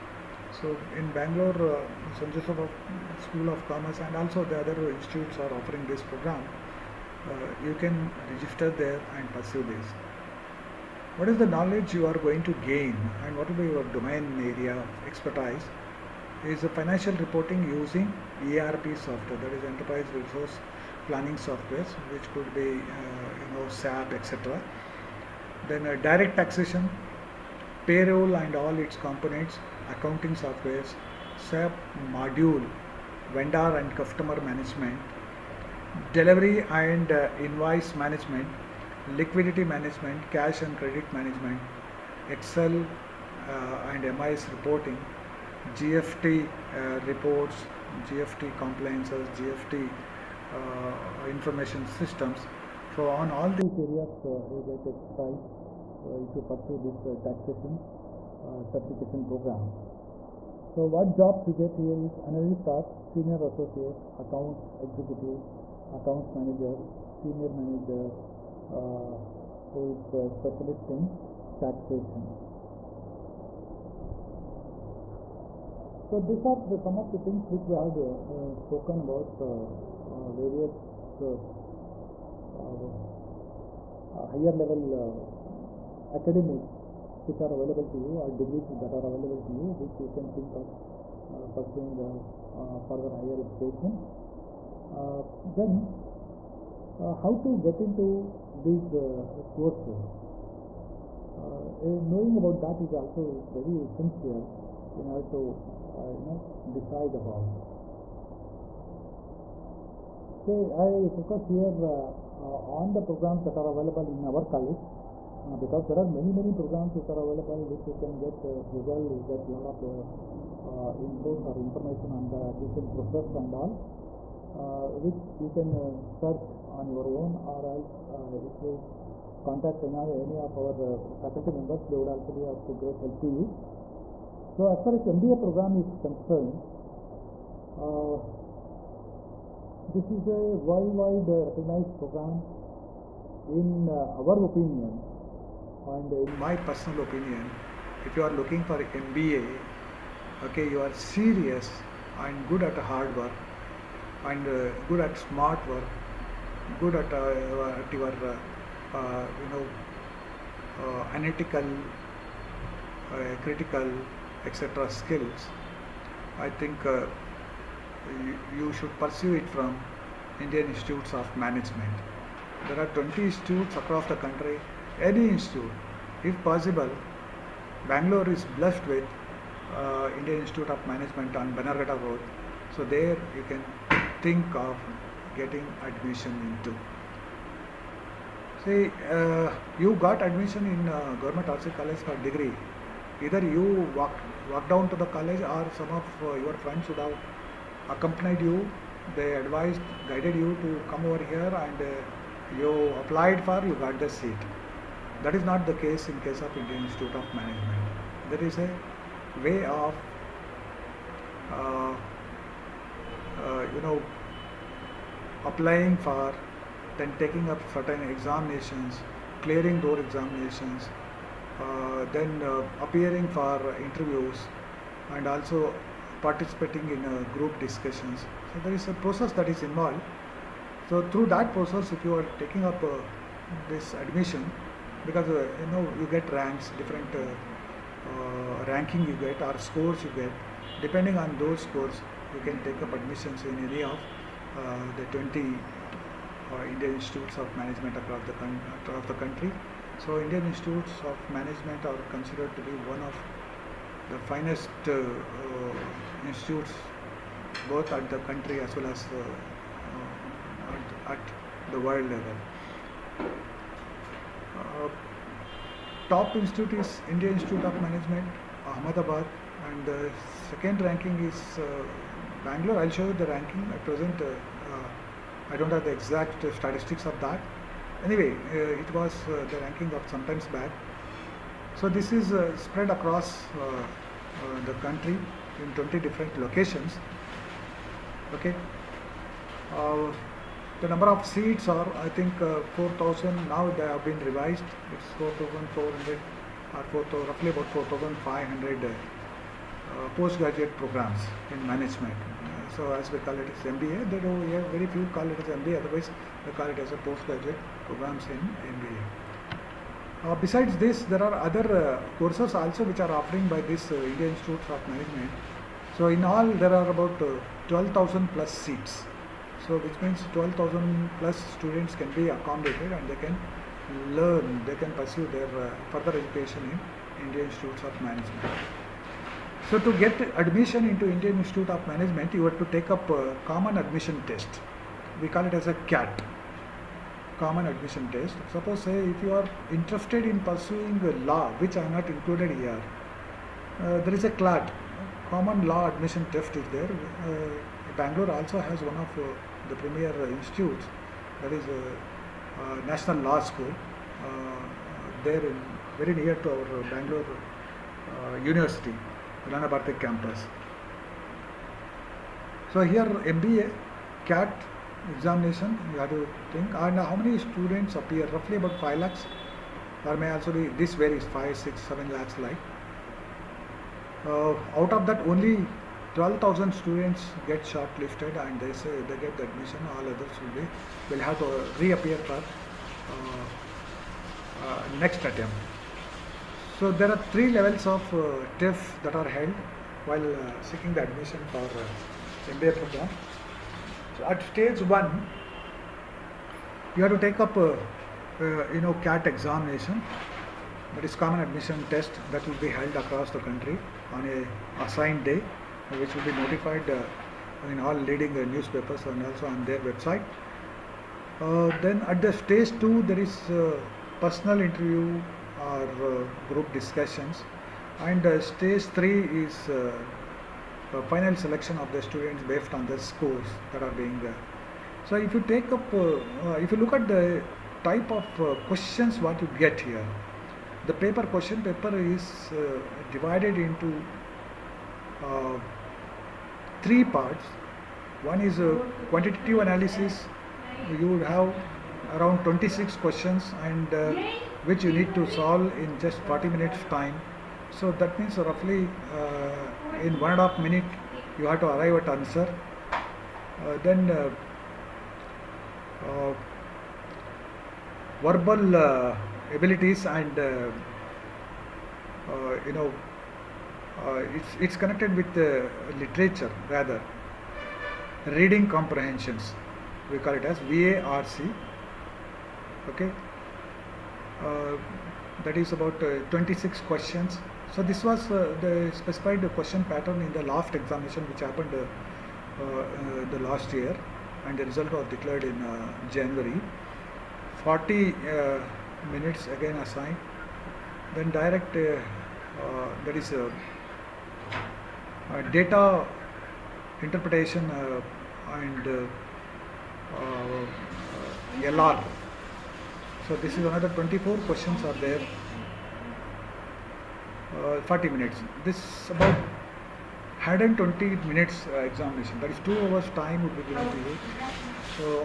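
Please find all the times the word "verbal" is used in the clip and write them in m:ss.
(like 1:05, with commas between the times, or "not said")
7:38.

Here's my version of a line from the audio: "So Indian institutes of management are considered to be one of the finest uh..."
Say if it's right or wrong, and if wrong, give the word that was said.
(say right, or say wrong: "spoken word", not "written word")
right.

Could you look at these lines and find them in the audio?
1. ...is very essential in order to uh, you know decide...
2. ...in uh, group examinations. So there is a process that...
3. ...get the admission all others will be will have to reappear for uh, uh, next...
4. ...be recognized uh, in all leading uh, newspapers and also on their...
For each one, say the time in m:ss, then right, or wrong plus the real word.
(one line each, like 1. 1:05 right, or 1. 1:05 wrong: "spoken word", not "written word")
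1. 1:43 right
2. 3:46 wrong: "discussions", not "examinations"
3. 6:19 right
4. 6:46 wrong: "notified", not "recognized".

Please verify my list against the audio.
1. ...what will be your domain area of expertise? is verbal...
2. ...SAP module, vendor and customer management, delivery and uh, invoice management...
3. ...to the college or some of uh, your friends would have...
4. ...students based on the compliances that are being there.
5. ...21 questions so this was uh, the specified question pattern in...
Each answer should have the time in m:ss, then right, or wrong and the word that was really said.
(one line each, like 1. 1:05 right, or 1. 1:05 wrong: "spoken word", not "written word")
1. 0:13 wrong: "financial", not "verbal"
2. 0:31 right
3. 3:14 right
4. 7:02 wrong: "scores", not "compliances"
5. 7:56 wrong: "26", not "21".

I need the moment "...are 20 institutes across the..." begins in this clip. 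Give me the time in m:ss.
2:52.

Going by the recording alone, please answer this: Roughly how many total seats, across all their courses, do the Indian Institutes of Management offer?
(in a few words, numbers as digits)
12,000.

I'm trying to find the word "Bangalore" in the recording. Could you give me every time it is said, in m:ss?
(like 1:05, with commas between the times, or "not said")
0:01, 2:57, 4:32, 5:47, 5:56.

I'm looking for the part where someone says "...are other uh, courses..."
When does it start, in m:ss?
5:11.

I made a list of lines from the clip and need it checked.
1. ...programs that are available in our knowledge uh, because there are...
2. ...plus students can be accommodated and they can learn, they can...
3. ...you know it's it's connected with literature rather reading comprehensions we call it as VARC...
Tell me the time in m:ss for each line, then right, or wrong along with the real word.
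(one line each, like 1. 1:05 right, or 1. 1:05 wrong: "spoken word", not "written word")
1. 1:53 wrong: "college", not "knowledge"
2. 5:21 right
3. 7:42 right.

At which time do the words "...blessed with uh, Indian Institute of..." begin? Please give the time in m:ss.
2:58.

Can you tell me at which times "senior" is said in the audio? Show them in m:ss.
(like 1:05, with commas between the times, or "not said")
1:03, 1:07.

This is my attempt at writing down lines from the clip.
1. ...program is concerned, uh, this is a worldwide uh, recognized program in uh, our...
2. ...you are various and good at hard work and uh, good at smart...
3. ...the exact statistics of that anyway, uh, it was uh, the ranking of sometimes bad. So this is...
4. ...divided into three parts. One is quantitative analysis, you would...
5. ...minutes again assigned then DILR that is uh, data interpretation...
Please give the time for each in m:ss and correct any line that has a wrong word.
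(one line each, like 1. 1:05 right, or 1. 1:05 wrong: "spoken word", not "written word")
1. 2:15 right
2. 2:30 wrong: "serious", not "various"
3. 4:35 right
4. 7:13 right
5. 8:09 right.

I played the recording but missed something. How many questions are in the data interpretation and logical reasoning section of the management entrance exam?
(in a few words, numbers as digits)
24.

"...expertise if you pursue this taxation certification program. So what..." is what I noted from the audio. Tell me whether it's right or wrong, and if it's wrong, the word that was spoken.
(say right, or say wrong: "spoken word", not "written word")
right.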